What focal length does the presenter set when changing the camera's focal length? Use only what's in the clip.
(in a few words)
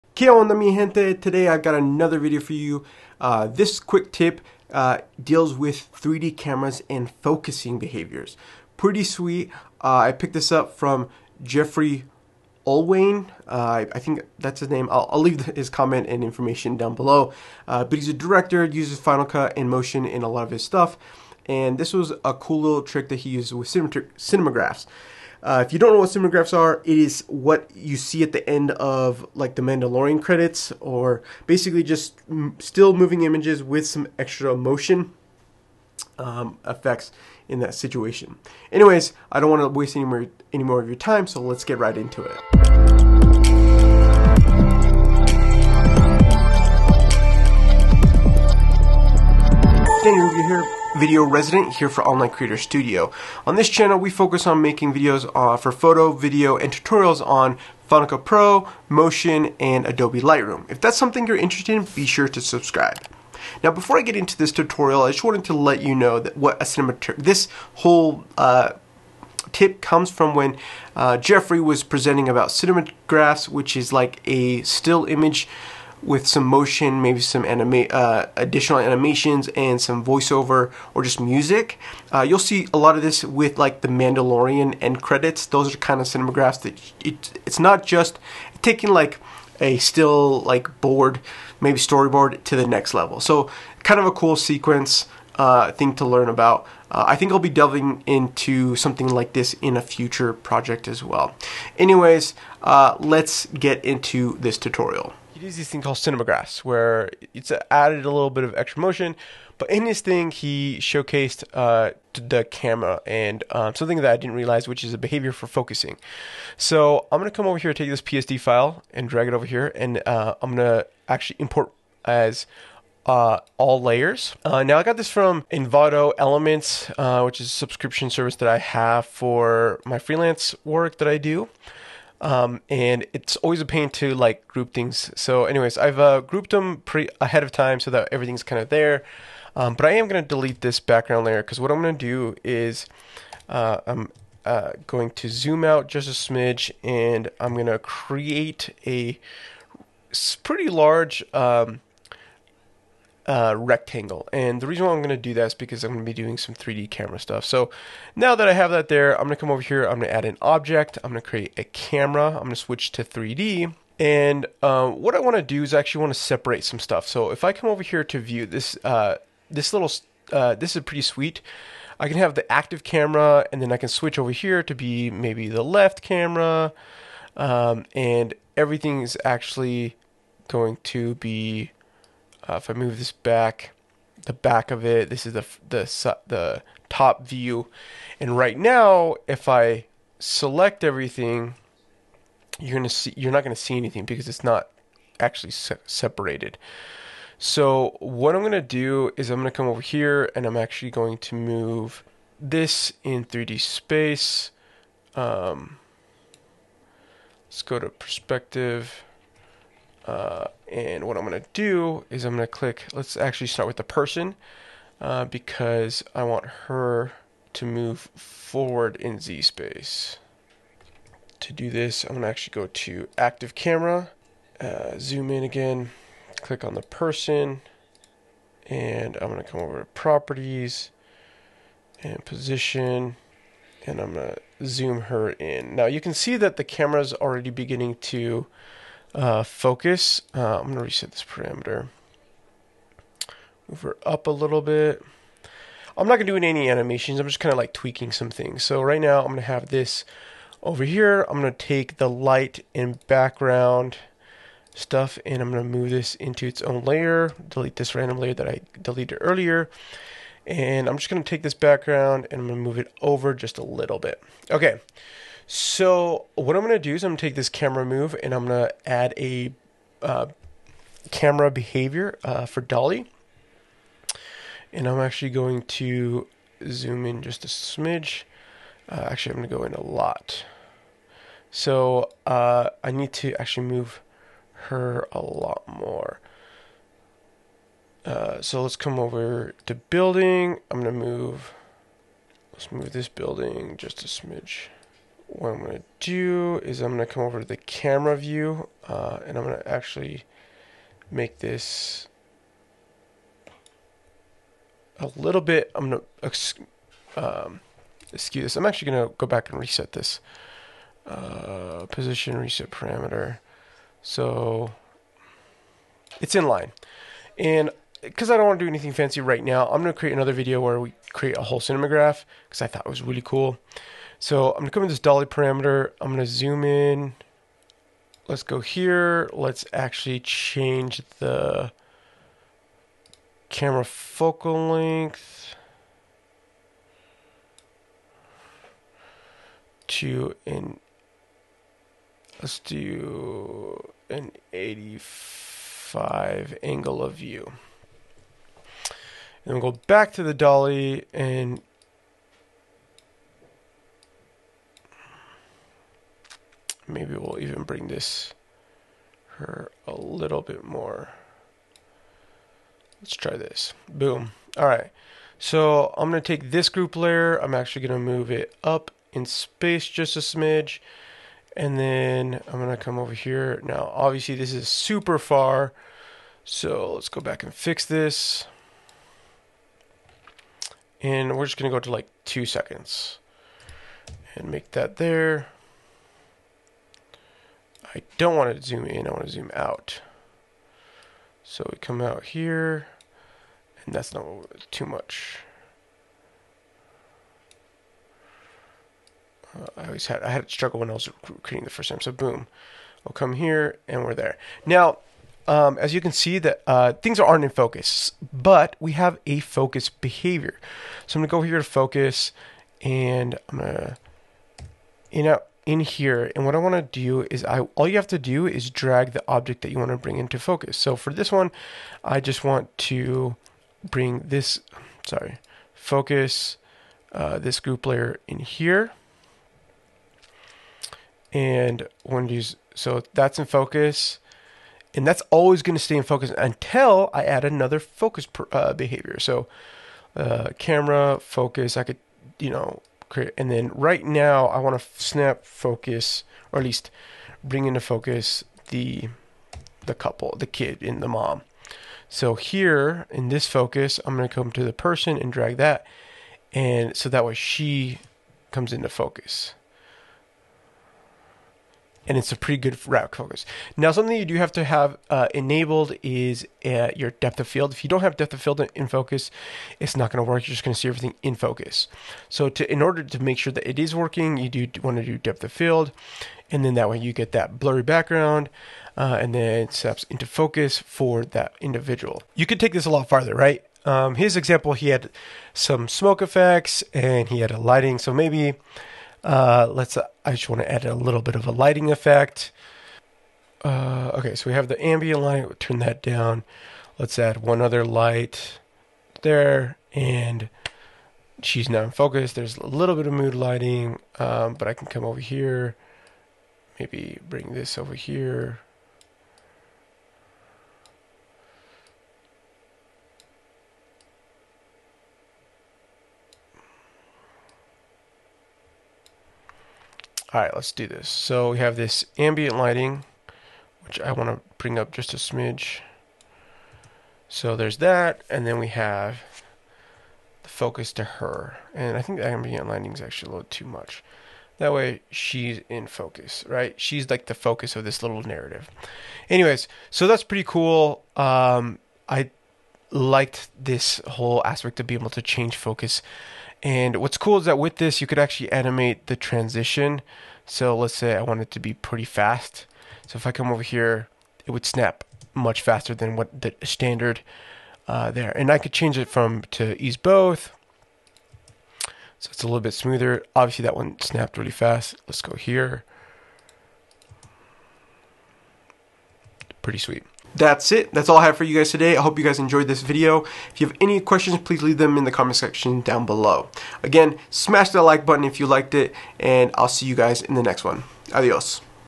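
85.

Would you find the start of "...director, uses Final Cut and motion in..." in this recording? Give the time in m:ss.
0:18.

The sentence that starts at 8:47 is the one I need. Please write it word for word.
So there's that, and then we have the focus to her.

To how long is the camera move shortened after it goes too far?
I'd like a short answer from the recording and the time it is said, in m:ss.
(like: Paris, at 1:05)
2 seconds, at 6:22.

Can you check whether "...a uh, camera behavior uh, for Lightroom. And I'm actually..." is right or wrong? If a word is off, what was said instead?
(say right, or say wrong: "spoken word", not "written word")
wrong: "Dolly", not "Lightroom".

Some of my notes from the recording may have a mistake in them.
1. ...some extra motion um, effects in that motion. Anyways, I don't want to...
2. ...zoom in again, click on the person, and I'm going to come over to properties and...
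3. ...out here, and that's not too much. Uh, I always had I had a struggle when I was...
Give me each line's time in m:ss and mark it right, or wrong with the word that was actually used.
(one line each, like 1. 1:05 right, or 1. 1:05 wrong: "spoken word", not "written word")
1. 0:33 wrong: "situation", not "motion"
2. 3:44 right
3. 6:32 right.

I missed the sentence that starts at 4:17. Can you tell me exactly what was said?
Delete this random layer that I deleted earlier.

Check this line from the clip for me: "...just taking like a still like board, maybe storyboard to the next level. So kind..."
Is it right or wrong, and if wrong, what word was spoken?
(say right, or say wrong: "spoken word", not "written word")
right.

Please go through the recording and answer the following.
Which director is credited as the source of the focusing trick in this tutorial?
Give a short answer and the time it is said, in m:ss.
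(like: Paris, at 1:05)
Geoffrey Orthwein, at 0:11.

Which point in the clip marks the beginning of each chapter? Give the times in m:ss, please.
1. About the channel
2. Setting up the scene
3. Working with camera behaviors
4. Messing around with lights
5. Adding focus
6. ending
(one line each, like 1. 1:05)
1. 0:53
2. 1:49
3. 4:25
4. 7:59
5. 6:42
6. 9:30.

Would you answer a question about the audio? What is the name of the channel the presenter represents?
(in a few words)
Online Creator Studio.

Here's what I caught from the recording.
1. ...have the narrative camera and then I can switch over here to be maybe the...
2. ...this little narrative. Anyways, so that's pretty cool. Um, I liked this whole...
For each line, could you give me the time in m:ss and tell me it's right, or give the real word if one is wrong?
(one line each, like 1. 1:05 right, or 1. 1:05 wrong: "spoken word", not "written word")
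1. 2:52 wrong: "active", not "narrative"
2. 8:57 right.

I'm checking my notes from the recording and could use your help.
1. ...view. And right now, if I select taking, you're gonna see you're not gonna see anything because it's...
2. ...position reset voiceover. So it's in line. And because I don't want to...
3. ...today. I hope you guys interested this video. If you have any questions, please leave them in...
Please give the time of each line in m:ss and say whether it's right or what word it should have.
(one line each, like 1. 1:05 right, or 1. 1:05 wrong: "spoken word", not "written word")
1. 3:07 wrong: "everything", not "taking"
2. 5:11 wrong: "parameter", not "voiceover"
3. 9:31 wrong: "enjoyed", not "interested".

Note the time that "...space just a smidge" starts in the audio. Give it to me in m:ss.
6:09.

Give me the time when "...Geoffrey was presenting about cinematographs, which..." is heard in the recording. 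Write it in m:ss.
1:11.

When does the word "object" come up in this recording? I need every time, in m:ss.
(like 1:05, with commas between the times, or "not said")
2:40, 6:59.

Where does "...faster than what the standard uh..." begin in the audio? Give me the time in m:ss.
9:15.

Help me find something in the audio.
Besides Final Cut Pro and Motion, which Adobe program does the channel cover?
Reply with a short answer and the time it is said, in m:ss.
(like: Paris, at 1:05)
Adobe Lightroom, at 0:59.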